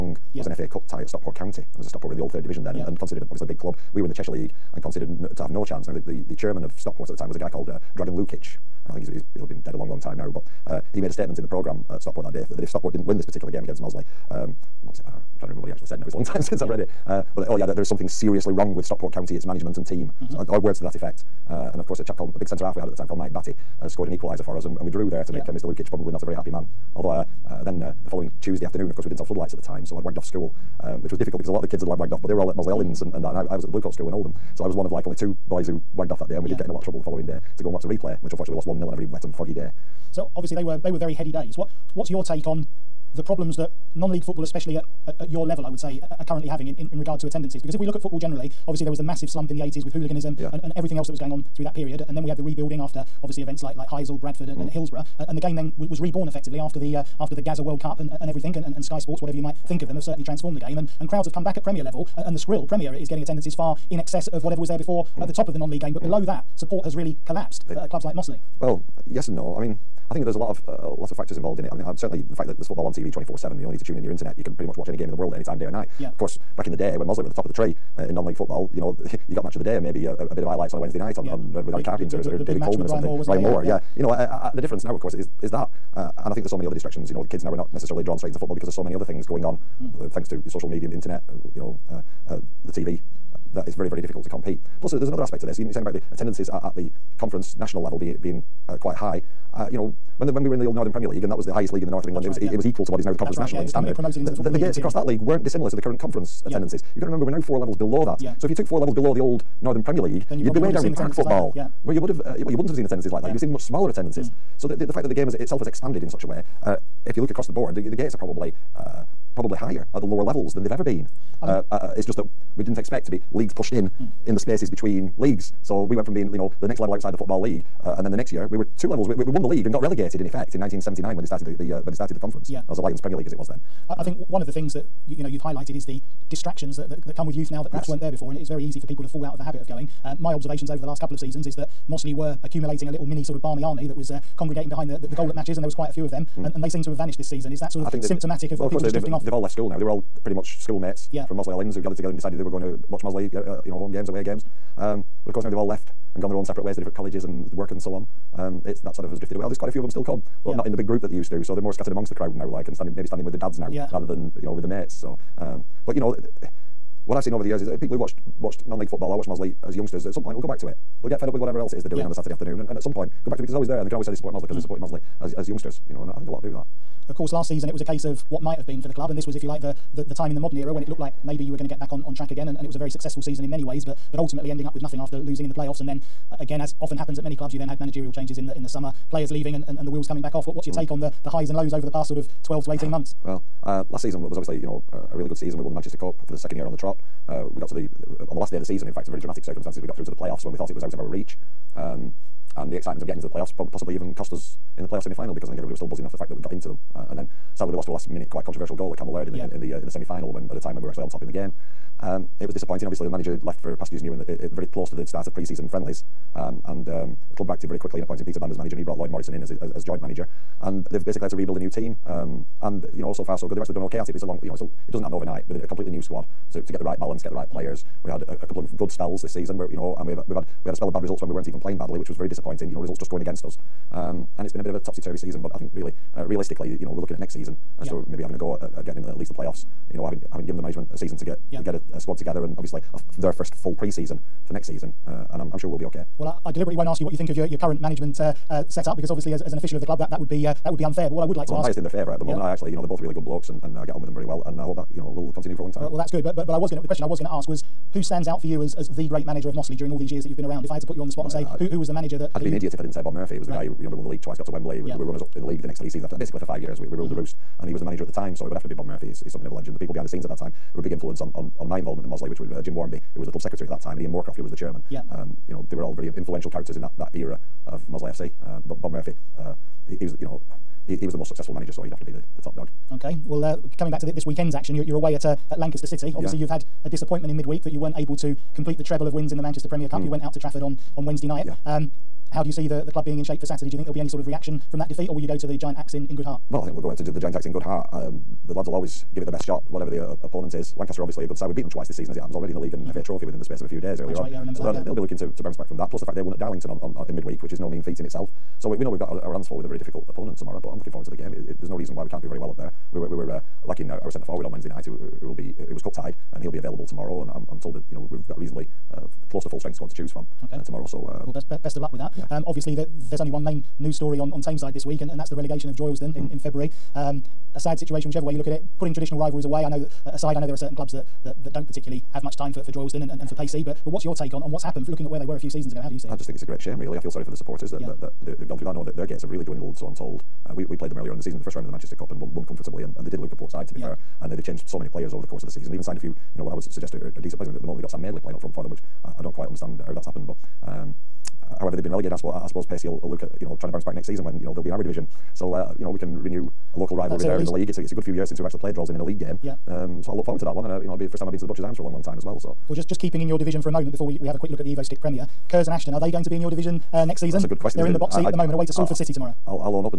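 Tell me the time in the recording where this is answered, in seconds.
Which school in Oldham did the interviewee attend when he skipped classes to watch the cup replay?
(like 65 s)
33 s.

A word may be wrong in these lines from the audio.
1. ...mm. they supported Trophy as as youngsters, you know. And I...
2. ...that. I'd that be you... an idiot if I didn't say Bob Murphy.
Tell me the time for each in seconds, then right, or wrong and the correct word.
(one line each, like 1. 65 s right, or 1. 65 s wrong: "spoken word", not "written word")
1. 174 s wrong: "Mossley", not "Trophy"
2. 262 s right.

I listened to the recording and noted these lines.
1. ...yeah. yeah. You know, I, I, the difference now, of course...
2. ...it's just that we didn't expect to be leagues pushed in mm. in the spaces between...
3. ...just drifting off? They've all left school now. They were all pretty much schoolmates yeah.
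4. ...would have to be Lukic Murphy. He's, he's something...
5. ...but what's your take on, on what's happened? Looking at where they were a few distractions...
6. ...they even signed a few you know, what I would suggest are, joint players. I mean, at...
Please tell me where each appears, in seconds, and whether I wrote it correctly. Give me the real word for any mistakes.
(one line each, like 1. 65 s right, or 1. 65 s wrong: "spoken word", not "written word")
1. 83 s right
2. 121 s right
3. 148 s right
4. 268 s wrong: "Bob", not "Lukic"
5. 333 s wrong: "seasons", not "distractions"
6. 345 s wrong: "decent", not "joint".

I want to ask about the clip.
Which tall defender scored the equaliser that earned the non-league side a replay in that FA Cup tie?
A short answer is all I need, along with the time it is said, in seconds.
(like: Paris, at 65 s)
Mike Batty, at 23 s.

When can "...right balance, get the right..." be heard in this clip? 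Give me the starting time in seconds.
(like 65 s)
226 s.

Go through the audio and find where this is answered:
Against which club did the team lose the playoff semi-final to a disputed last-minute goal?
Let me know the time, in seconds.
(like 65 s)
208 s.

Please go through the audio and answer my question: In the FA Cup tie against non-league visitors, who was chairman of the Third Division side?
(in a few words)
Dragan Lukic.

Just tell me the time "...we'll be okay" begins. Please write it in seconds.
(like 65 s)
245 s.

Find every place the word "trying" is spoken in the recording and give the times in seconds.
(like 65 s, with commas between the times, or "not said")
15 s, 353 s.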